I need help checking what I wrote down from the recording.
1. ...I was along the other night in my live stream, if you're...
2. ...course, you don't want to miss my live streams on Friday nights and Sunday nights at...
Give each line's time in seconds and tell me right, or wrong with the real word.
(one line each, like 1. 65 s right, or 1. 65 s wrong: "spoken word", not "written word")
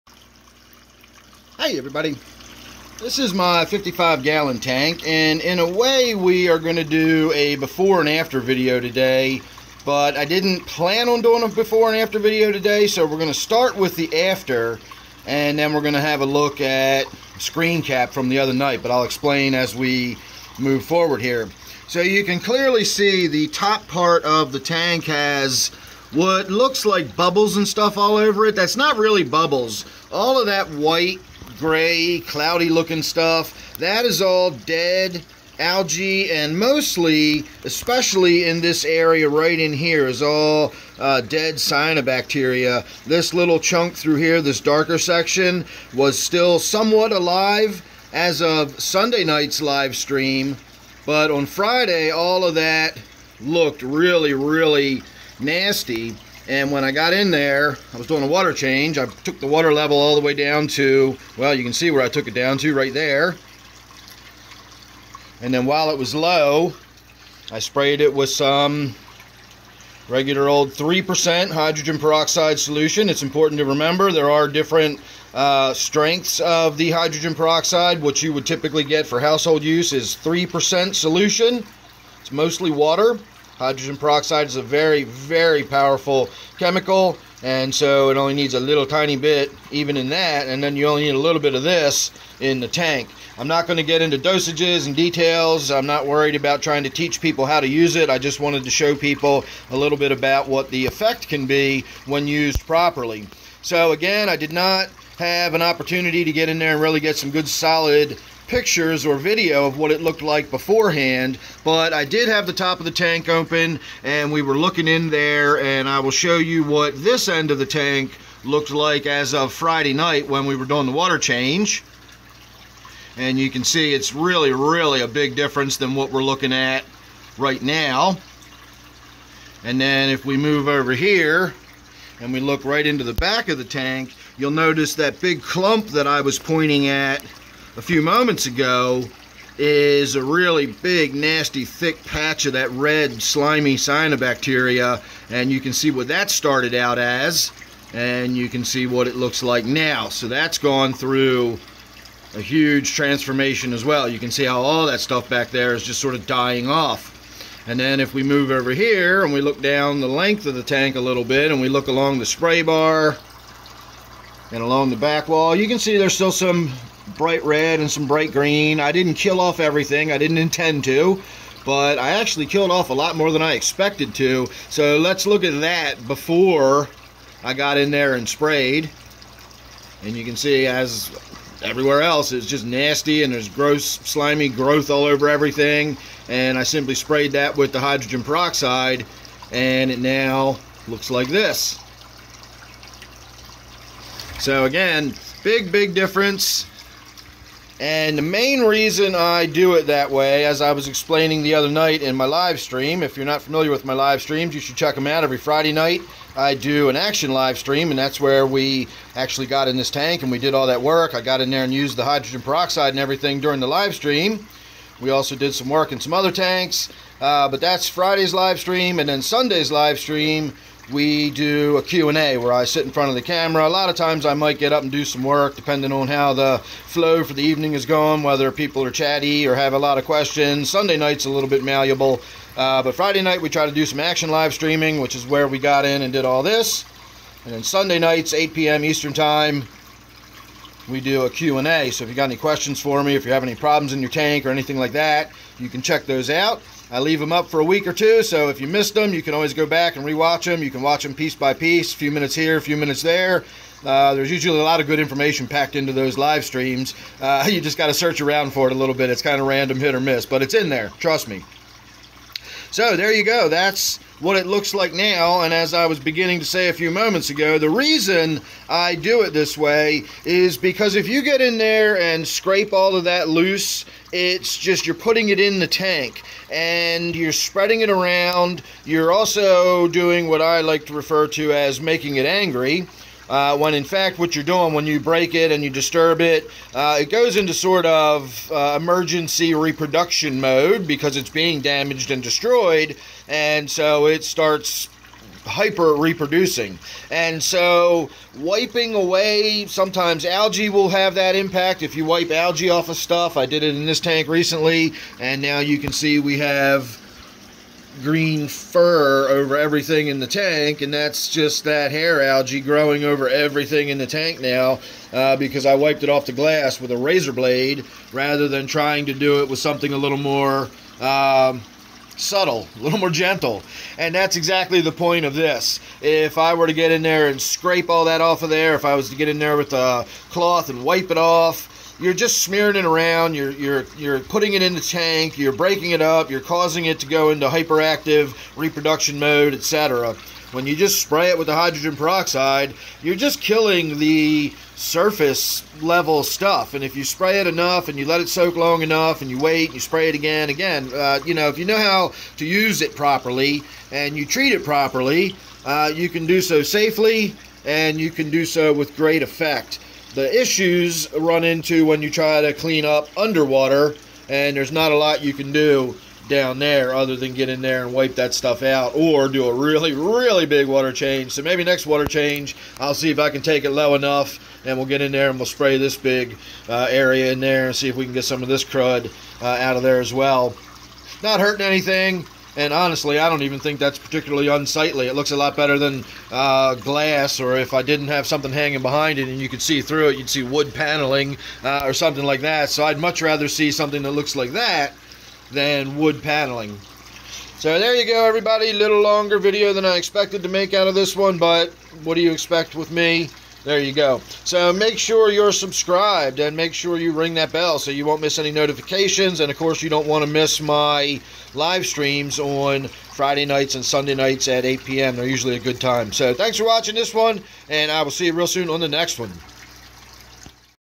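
1. 200 s wrong: "explaining", not "along"
2. 409 s right.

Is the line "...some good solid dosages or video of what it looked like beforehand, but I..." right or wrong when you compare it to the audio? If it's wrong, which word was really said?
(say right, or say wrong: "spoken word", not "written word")
wrong: "pictures", not "dosages".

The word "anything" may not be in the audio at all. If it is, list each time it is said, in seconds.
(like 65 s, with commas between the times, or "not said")
244 s, 381 s.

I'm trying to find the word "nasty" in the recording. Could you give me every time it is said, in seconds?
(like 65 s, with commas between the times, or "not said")
55 s, 141 s, 182 s.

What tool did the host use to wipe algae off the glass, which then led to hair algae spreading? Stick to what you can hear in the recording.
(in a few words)
Razor blade.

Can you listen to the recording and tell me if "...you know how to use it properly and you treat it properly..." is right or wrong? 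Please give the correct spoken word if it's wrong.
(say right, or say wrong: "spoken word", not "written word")
right.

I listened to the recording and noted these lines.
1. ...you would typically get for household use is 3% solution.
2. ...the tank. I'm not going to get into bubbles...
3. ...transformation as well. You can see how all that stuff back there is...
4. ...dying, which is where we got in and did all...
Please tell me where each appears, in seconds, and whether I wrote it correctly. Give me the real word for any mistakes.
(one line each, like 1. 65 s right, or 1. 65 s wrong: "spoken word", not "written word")
1. 78 s right
2. 92 s wrong: "dosages", not "bubbles"
3. 152 s right
4. 234 s wrong: "streaming", not "dying".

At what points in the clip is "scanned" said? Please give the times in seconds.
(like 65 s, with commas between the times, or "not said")
not said.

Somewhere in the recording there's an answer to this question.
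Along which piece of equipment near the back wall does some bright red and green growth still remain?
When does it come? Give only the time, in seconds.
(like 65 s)
162 s.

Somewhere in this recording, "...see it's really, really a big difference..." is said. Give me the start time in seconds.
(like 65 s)
123 s.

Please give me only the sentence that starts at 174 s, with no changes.
So let's look at that before I got in there and sprayed.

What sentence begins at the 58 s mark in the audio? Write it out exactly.
I took the water level all the way down to, well, you can see where I took it down to right there.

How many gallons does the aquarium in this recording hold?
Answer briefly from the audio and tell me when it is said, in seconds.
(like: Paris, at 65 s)
55 gallons, at 3 s.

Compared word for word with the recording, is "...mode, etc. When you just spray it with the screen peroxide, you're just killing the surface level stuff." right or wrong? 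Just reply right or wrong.
wrong.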